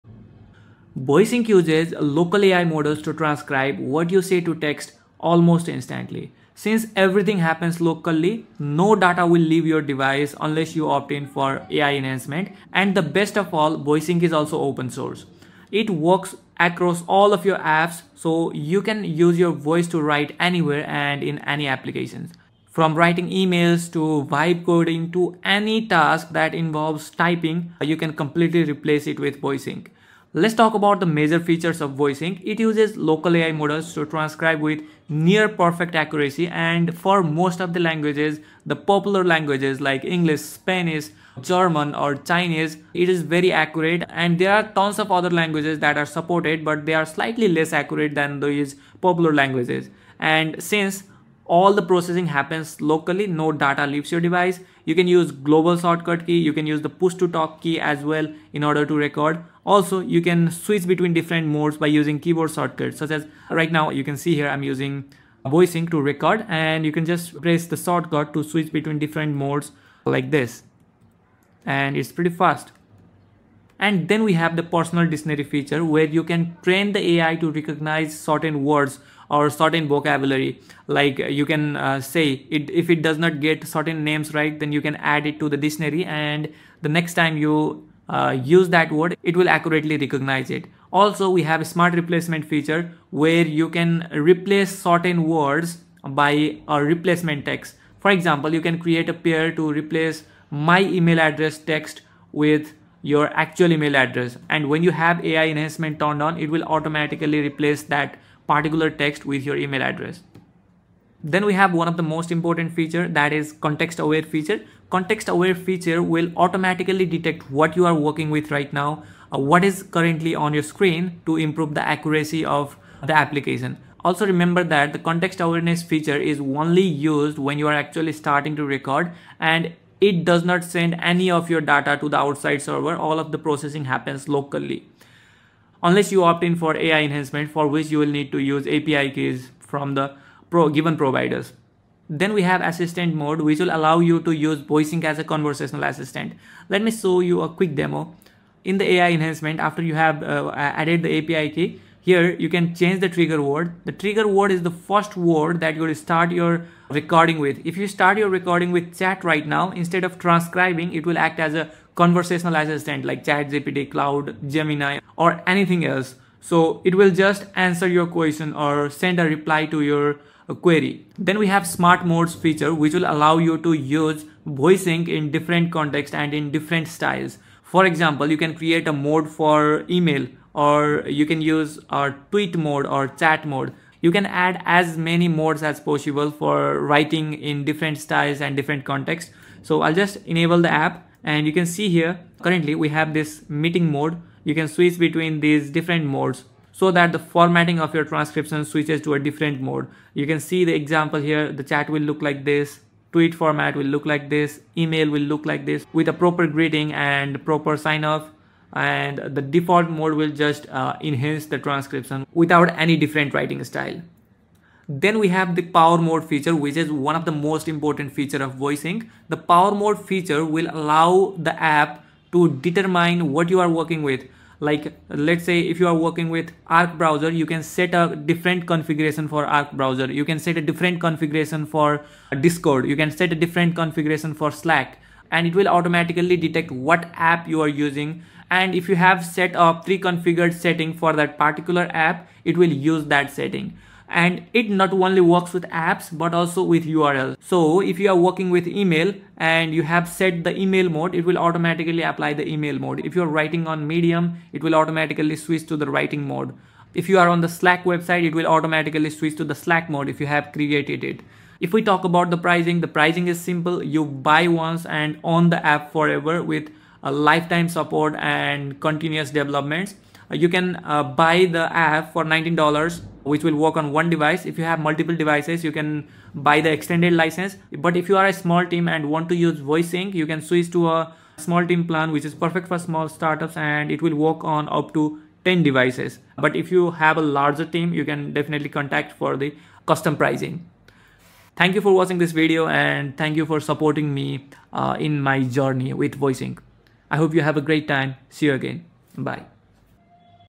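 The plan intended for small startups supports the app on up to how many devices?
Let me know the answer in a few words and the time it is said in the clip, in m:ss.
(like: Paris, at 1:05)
10, at 4:45.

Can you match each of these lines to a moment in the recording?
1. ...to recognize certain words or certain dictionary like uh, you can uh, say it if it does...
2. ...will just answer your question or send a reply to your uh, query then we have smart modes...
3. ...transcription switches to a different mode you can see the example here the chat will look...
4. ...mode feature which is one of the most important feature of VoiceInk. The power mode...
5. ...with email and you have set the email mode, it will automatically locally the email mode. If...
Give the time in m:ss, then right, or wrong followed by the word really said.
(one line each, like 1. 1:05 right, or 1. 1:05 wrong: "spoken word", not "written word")
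1. 1:17 wrong: "vocabulary", not "dictionary"
2. 2:46 right
3. 3:18 right
4. 3:35 right
5. 4:08 wrong: "apply", not "locally".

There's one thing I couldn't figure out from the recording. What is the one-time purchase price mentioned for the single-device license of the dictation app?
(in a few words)
$19.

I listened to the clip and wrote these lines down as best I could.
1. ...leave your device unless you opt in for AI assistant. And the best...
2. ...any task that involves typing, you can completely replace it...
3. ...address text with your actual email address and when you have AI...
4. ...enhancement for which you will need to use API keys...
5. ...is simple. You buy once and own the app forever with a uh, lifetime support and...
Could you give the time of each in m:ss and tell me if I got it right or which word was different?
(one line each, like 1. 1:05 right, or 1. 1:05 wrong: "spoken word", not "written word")
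1. 0:09 wrong: "enhancement", not "assistant"
2. 0:25 right
3. 1:41 right
4. 2:17 right
5. 4:23 right.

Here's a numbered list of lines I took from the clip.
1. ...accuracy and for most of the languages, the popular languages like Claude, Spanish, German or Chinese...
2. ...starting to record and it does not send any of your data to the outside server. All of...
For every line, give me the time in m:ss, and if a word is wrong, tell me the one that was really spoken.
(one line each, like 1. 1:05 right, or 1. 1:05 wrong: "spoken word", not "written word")
1. 0:35 wrong: "English", not "Claude"
2. 2:08 right.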